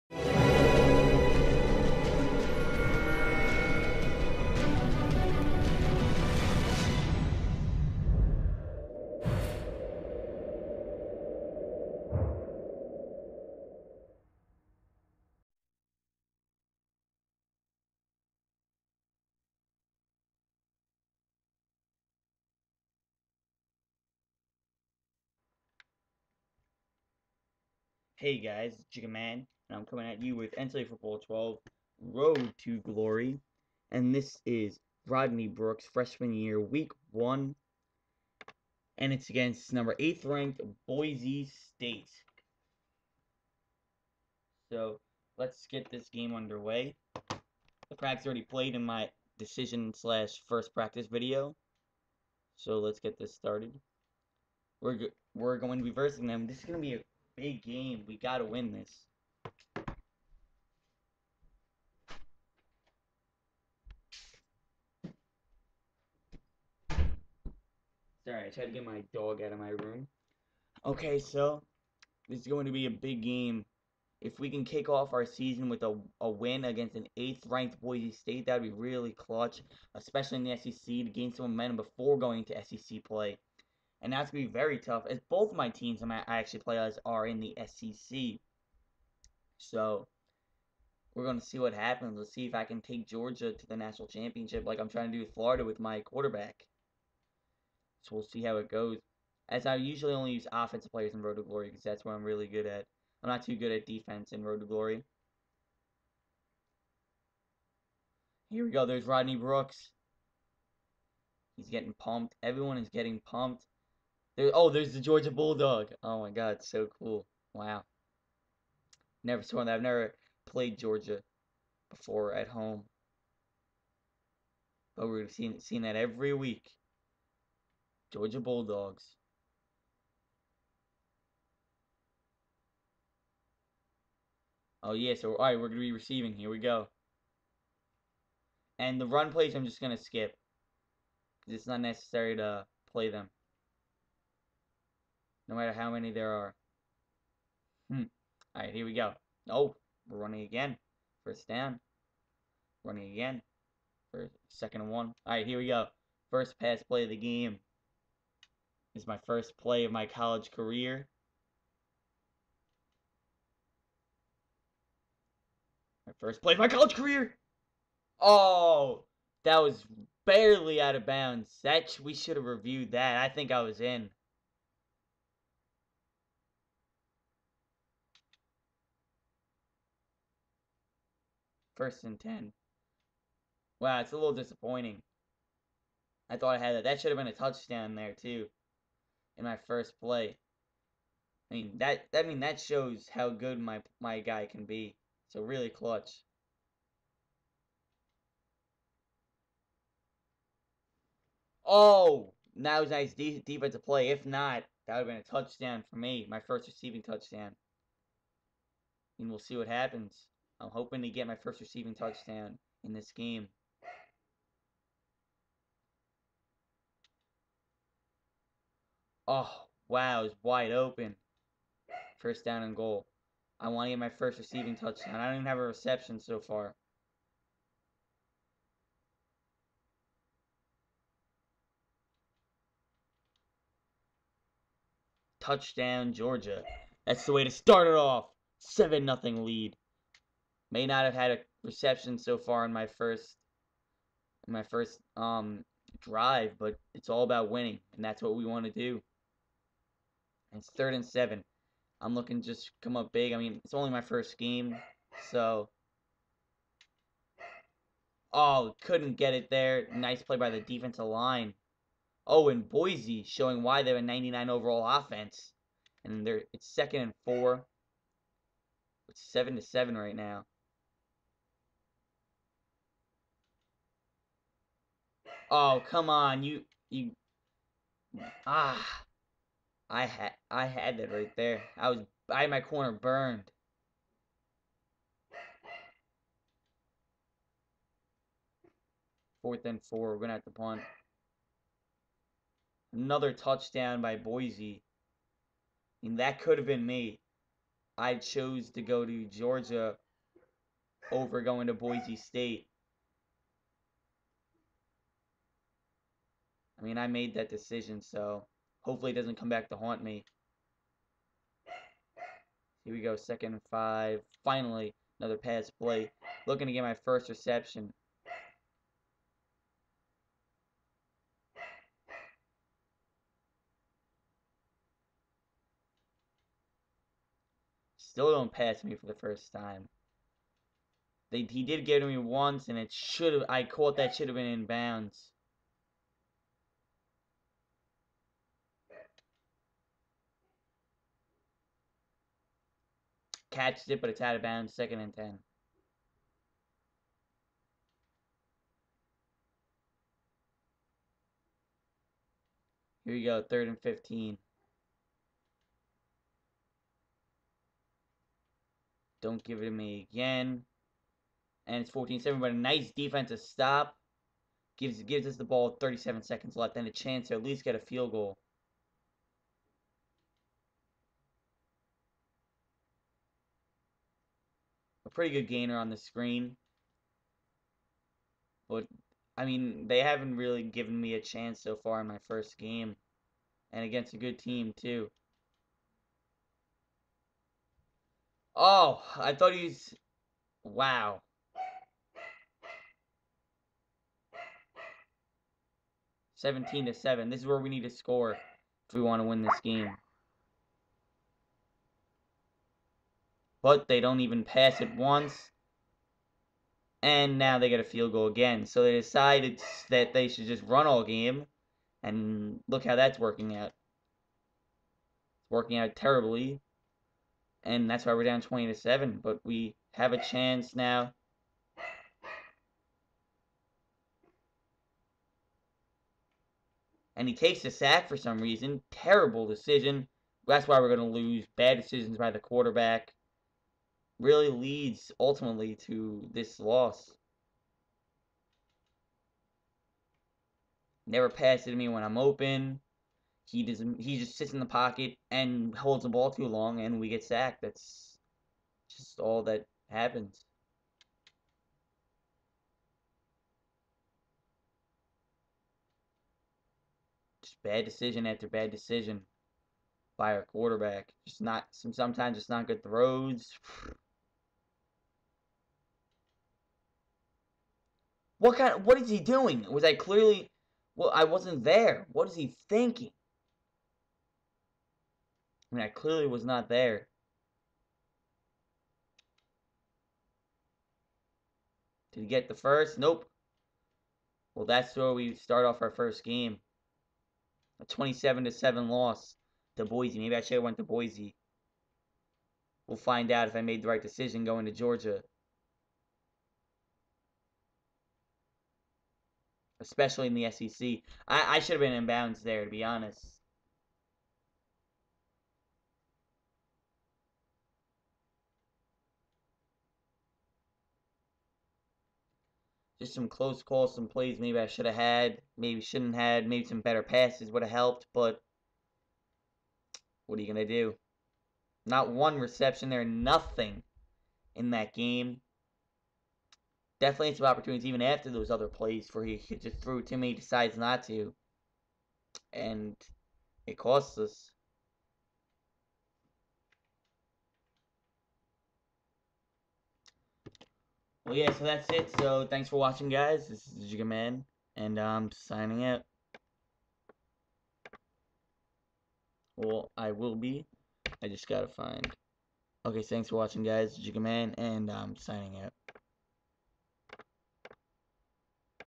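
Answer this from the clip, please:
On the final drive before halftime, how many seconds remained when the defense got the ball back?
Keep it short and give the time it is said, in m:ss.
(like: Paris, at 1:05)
37, at 6:05.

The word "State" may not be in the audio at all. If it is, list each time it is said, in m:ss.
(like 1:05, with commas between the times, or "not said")
0:41, 1:18, 5:02.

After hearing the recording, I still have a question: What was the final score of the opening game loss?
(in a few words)
27 to 7.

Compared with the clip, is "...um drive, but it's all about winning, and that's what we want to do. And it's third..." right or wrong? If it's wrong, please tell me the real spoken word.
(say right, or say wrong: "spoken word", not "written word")
right.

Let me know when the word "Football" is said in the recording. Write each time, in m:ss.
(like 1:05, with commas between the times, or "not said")
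0:30.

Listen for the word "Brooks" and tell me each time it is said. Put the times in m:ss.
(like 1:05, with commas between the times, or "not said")
0:35, 1:49.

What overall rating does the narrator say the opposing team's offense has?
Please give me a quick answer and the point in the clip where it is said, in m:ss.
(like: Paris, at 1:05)
99, at 4:24.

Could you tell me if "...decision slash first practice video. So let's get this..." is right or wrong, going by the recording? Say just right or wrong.
right.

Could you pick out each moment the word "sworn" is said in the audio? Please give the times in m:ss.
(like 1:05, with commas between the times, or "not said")
1:59.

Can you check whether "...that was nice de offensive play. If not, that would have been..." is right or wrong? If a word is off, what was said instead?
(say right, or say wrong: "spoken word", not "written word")
wrong: "defensive", not "offensive".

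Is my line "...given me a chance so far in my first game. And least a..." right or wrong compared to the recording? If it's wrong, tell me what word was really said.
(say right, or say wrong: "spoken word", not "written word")
wrong: "against", not "least".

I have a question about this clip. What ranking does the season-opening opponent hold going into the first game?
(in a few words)
8th.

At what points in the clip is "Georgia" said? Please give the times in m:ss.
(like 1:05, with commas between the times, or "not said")
1:33, 1:55, 2:00, 2:08, 3:56, 4:59, 8:14.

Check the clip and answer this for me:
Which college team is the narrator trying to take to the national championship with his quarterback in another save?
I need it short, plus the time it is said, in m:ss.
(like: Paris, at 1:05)
Florida, at 1:35.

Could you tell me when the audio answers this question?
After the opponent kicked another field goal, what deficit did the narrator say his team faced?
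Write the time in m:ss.
6:58.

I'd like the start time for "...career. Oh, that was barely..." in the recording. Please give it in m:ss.
2:46.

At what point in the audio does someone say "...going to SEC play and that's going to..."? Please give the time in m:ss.
1:22.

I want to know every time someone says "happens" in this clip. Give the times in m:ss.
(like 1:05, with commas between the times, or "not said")
1:31, 3:29, 7:29.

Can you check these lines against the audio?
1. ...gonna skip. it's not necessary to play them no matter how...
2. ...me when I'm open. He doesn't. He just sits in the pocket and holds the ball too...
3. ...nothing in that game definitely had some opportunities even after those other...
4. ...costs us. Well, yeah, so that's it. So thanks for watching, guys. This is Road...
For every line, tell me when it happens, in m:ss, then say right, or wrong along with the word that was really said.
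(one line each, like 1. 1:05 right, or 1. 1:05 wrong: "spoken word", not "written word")
1. 2:19 right
2. 7:21 right
3. 8:43 right
4. 8:53 wrong: "Jigga", not "Road".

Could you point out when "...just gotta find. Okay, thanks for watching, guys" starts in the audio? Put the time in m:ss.
9:11.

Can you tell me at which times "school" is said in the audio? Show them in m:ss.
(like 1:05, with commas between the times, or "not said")
not said.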